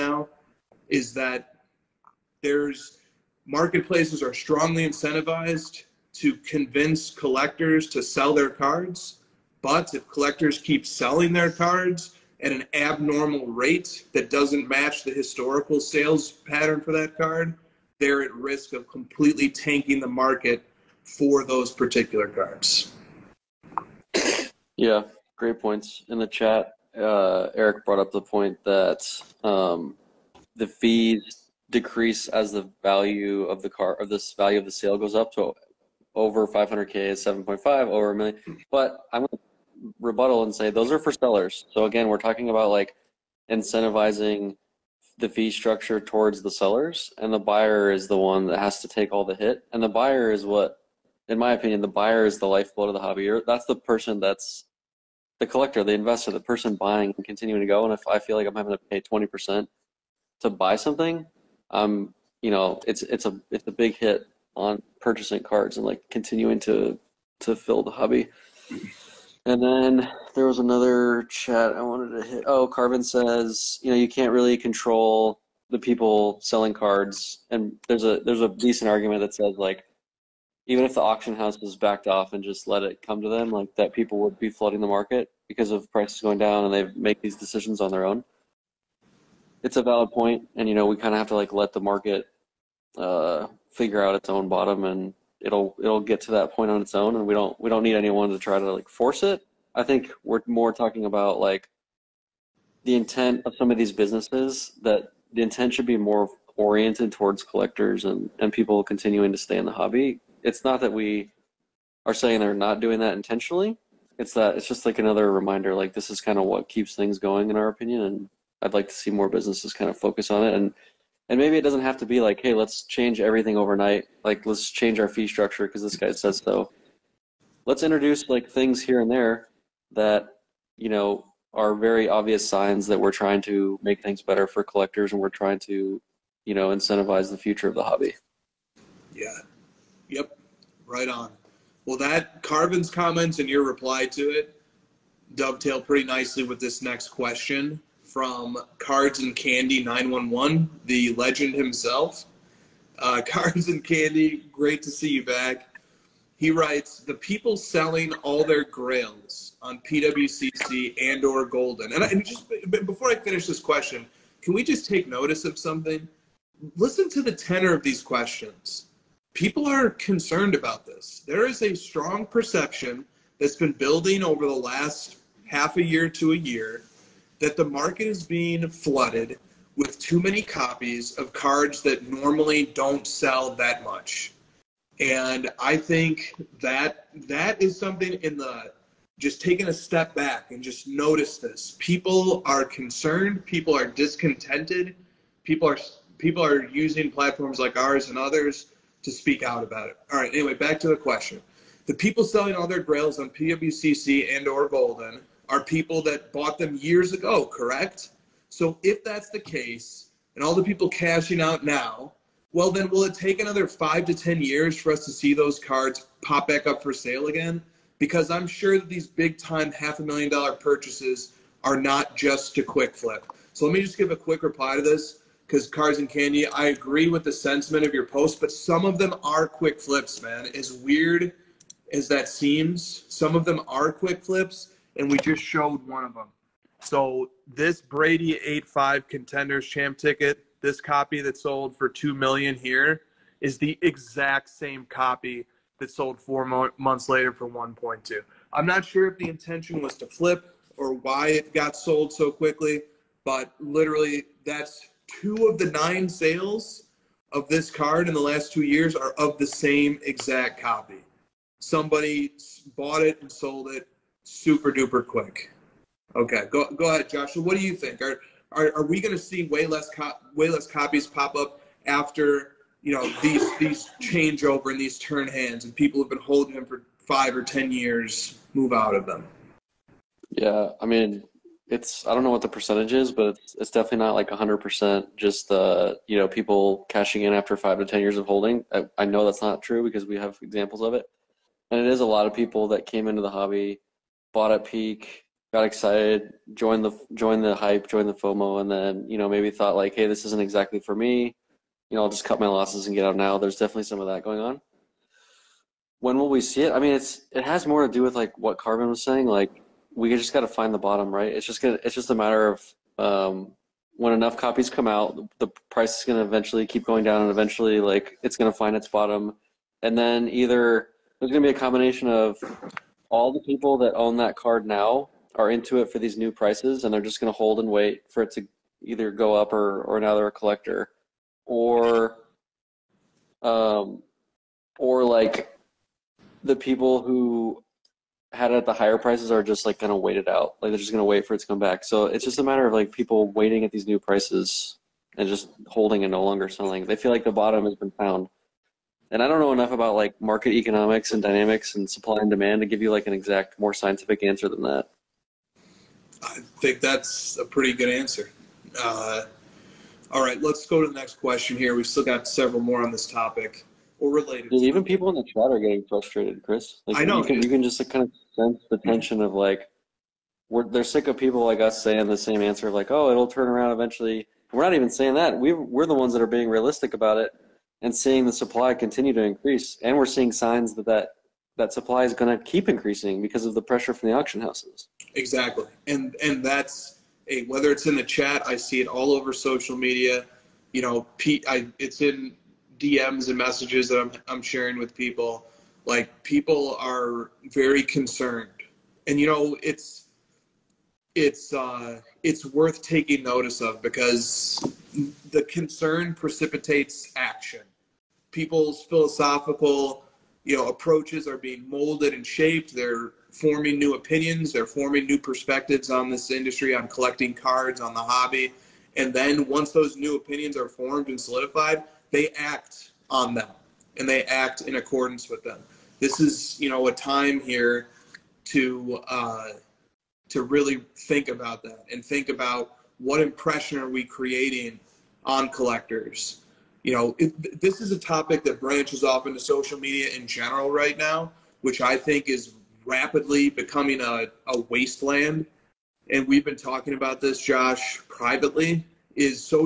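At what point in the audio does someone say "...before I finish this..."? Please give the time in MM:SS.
02:42.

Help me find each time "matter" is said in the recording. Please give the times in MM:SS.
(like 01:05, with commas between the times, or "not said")
05:12, 05:42.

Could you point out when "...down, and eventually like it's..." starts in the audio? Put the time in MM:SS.
05:17.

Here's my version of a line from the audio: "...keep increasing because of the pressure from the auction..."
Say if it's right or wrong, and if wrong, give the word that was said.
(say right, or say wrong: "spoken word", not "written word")
right.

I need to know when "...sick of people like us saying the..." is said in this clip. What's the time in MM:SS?
06:10.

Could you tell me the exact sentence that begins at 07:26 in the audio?
And we've been talking about this, Josh, privately.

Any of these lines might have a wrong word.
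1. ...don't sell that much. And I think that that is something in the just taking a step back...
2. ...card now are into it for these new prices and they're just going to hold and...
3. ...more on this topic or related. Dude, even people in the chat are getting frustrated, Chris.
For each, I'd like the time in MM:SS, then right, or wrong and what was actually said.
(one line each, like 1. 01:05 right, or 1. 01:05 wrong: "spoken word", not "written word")
1. 03:02 right
2. 05:24 right
3. 06:02 right.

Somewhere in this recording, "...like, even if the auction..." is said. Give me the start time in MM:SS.
01:19.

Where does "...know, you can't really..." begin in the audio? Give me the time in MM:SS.
01:13.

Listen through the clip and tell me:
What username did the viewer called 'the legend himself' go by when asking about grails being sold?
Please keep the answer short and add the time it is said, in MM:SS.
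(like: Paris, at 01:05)
Cards and Candy 911, at 02:28.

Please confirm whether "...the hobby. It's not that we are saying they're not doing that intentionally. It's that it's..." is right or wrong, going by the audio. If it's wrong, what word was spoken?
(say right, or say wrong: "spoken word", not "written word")
right.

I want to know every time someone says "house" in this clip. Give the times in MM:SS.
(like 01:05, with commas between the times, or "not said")
01:21, 06:24.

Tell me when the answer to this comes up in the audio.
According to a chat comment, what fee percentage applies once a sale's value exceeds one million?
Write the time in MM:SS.
00:37.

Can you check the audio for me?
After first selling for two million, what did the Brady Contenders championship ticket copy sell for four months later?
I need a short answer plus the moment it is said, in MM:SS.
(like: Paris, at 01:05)
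1.2 million, at 04:07.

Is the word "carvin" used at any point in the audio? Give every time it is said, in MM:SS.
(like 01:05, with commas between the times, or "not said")
01:12, 02:22, 05:08.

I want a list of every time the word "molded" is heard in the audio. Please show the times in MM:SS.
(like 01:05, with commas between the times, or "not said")
06:51.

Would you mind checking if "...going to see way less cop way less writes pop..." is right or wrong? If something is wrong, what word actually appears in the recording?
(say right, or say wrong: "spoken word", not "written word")
wrong: "copies", not "writes".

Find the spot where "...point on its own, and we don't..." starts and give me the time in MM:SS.
01:36.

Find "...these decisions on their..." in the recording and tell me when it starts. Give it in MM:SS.
01:27.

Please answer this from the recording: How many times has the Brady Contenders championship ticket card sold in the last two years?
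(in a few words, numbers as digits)
9.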